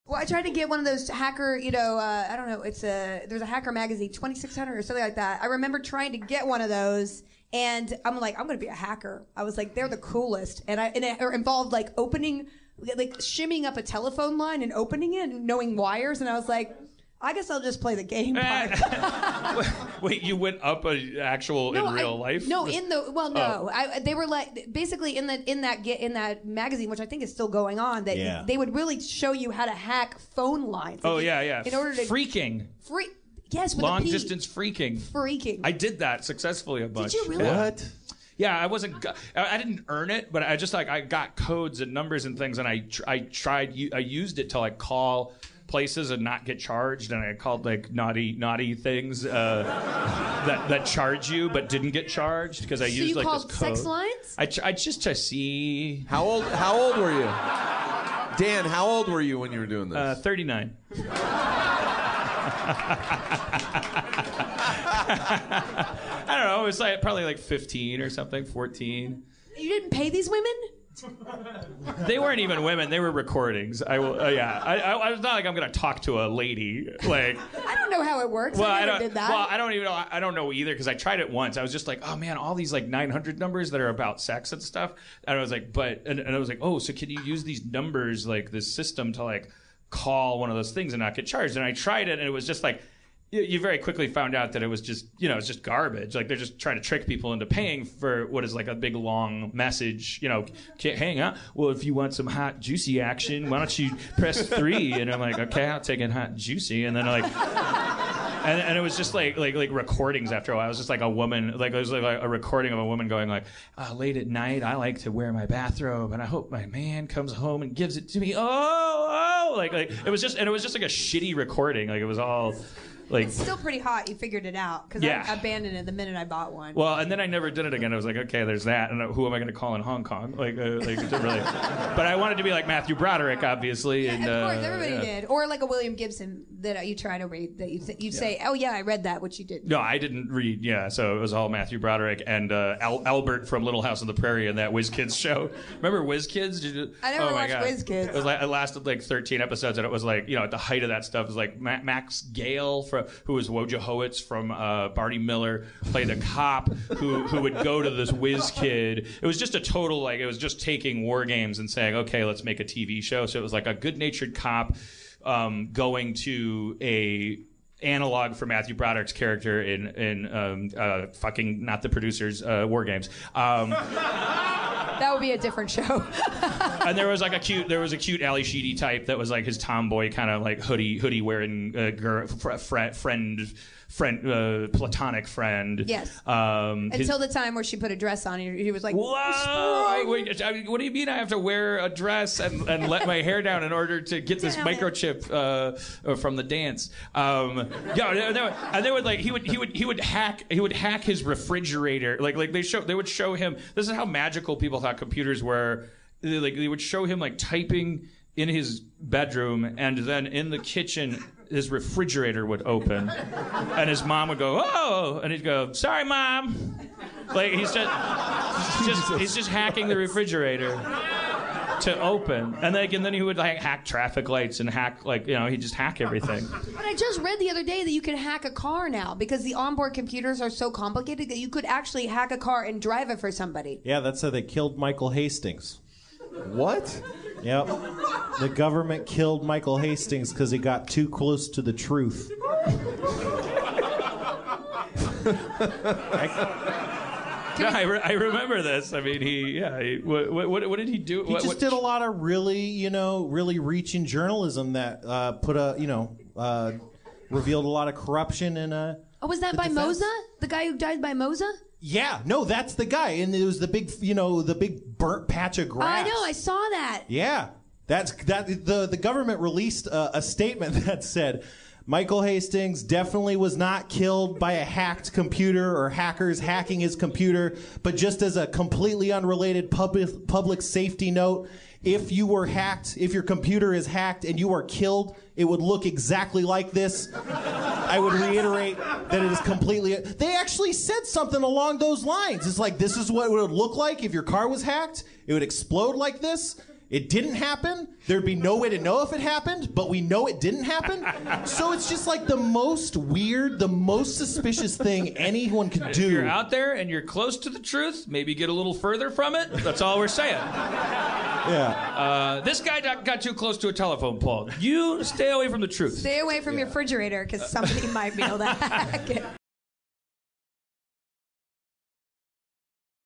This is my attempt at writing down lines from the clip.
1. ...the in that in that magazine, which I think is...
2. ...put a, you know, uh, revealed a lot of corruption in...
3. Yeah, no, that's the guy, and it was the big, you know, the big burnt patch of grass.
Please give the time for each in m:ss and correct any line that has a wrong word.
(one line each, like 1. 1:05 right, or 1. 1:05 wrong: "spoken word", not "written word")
1. 0:25 right
2. 4:15 right
3. 4:21 right.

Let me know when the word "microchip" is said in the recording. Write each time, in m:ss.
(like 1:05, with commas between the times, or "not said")
3:14.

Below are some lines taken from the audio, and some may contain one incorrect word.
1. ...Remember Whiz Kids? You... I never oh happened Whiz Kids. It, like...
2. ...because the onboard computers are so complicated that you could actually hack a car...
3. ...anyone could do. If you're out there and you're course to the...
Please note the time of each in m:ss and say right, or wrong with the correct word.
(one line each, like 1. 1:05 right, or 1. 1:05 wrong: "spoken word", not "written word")
1. 2:25 wrong: "watched", not "happened"
2. 3:49 right
3. 5:05 wrong: "close", not "course".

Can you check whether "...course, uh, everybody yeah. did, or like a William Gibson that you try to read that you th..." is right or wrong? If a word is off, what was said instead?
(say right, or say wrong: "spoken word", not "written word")
right.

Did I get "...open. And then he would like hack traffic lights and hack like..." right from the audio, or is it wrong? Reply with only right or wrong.
right.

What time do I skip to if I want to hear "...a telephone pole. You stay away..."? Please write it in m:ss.
5:13.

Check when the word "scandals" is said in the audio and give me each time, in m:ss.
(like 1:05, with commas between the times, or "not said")
not said.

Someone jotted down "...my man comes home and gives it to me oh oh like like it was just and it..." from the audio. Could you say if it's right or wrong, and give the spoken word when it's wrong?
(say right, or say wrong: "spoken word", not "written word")
right.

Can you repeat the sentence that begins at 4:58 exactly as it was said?
There'd be no way to know if it happened, but we know it didn't happen.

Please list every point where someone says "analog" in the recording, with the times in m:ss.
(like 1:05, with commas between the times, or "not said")
2:47.